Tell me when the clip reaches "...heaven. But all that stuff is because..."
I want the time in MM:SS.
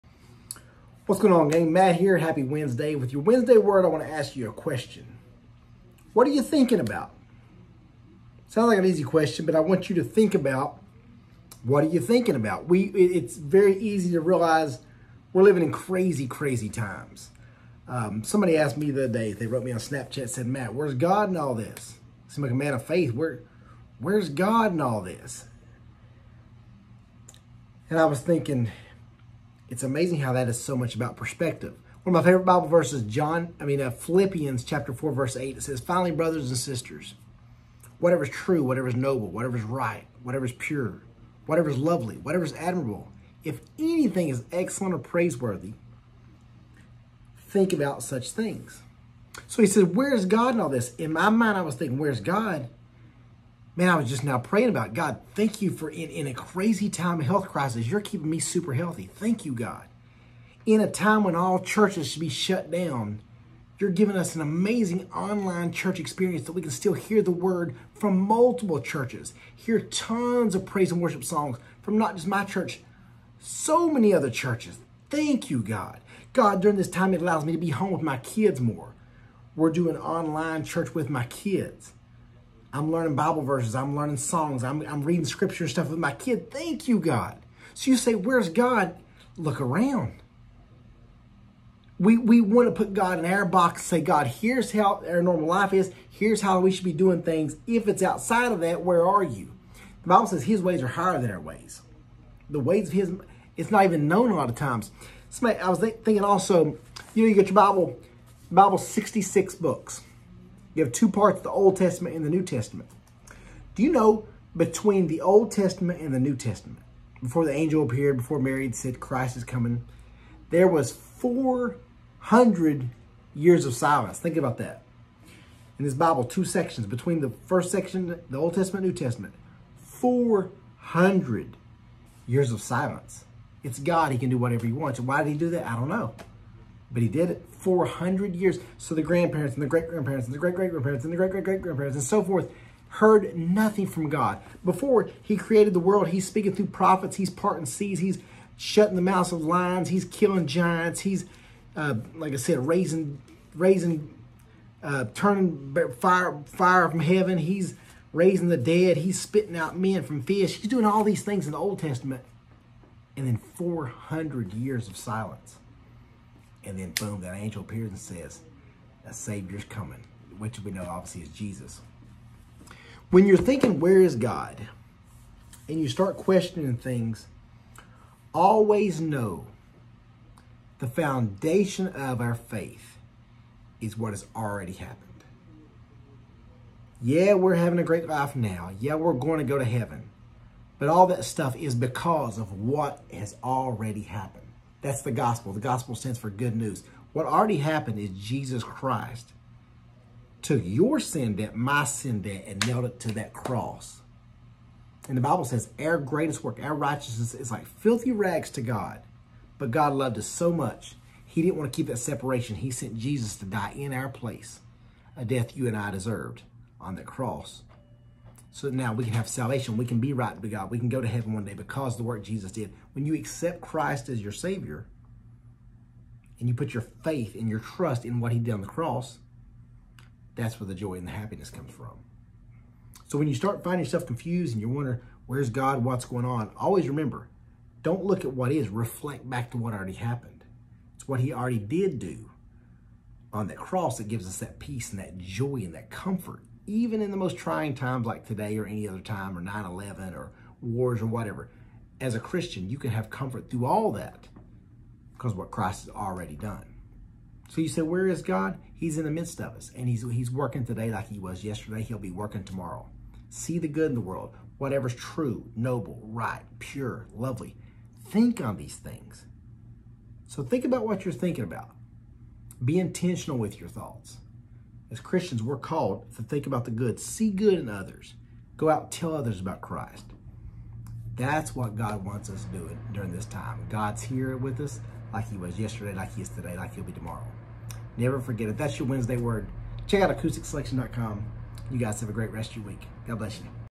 03:09.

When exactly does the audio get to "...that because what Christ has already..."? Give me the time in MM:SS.
04:13.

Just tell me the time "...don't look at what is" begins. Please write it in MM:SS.
03:57.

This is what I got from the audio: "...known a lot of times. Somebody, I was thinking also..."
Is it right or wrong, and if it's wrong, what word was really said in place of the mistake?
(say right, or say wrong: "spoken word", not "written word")
right.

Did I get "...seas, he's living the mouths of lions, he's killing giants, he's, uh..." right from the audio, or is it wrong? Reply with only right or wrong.
wrong.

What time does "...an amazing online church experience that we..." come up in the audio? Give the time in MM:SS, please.
01:04.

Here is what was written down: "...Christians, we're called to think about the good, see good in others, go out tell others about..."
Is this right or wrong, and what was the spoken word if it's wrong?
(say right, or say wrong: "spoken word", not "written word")
right.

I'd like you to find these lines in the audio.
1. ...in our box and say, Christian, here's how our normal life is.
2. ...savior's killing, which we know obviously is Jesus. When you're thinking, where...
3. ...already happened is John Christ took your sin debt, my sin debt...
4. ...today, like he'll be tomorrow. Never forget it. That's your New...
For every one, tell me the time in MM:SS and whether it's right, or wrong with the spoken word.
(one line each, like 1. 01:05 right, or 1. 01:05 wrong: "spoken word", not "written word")
1. 01:33 wrong: "God", not "Christian"
2. 02:49 wrong: "coming", not "killing"
3. 03:17 wrong: "Jesus", not "John"
4. 04:46 wrong: "Wednesday", not "New".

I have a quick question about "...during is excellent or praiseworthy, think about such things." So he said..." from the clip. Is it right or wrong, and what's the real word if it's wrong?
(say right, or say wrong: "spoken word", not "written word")
wrong: "anything", not "during".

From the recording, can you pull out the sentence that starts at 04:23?
See the good in the world, whatever's true, noble, right, pure, lovely.